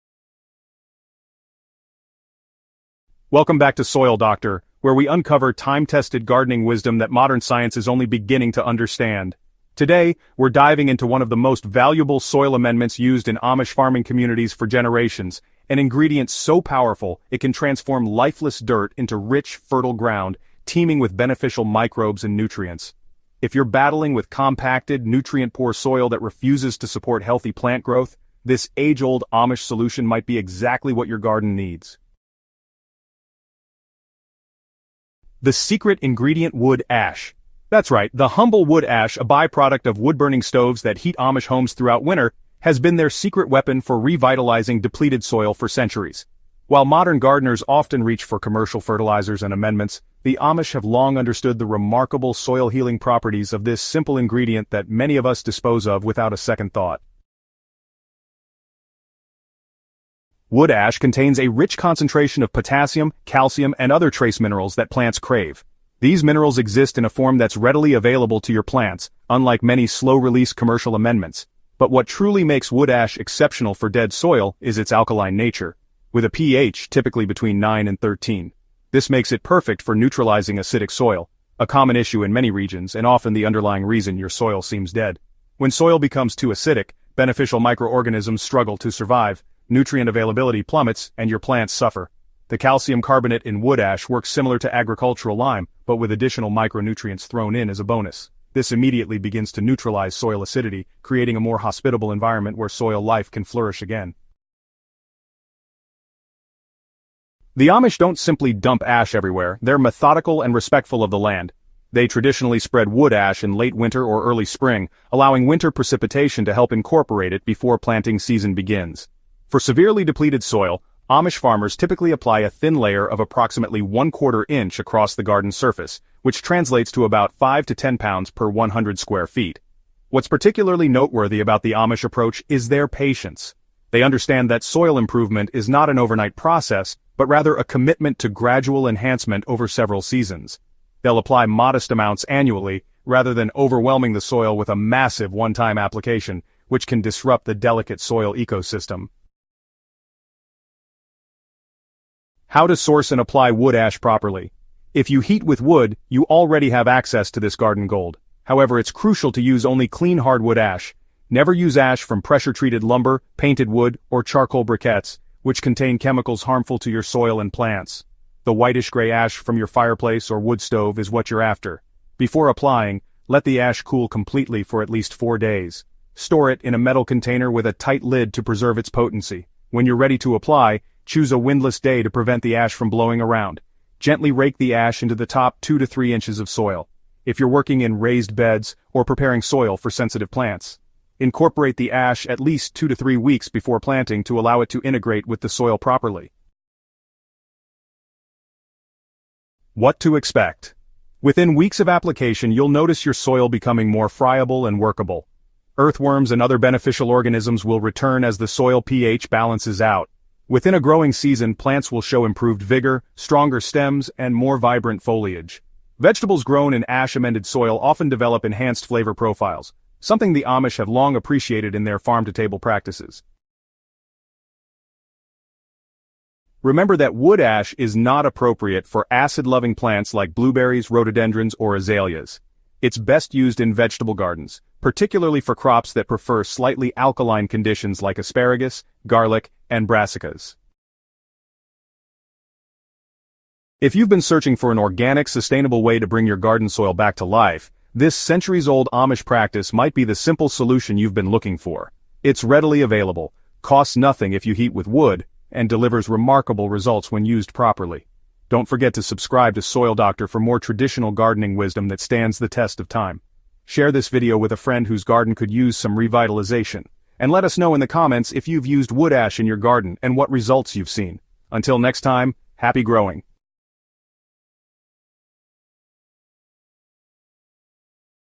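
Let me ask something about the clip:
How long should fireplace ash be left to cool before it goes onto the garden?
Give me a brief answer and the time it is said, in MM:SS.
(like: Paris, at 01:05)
4 days, at 02:55.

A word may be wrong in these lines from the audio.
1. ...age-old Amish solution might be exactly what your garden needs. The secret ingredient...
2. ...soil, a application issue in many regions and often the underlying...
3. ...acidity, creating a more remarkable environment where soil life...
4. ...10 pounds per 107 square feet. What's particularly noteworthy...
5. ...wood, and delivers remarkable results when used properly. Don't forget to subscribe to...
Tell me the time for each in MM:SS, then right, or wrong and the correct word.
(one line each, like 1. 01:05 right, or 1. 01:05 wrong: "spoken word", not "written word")
1. 00:28 right
2. 01:20 wrong: "common", not "application"
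3. 01:40 wrong: "hospitable", not "remarkable"
4. 02:07 wrong: "100", not "107"
5. 04:14 right.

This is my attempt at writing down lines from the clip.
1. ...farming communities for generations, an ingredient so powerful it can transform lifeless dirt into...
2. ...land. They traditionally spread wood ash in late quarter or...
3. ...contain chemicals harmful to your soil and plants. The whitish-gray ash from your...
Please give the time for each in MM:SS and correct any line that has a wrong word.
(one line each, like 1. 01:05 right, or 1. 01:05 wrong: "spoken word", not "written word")
1. 00:13 right
2. 01:51 wrong: "winter", not "quarter"
3. 02:45 right.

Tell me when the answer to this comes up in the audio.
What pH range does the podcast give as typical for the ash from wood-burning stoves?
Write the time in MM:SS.
01:17.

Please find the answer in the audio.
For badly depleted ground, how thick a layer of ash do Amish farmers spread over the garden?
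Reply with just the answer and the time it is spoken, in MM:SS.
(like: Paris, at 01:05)
1/4 inch, at 02:03.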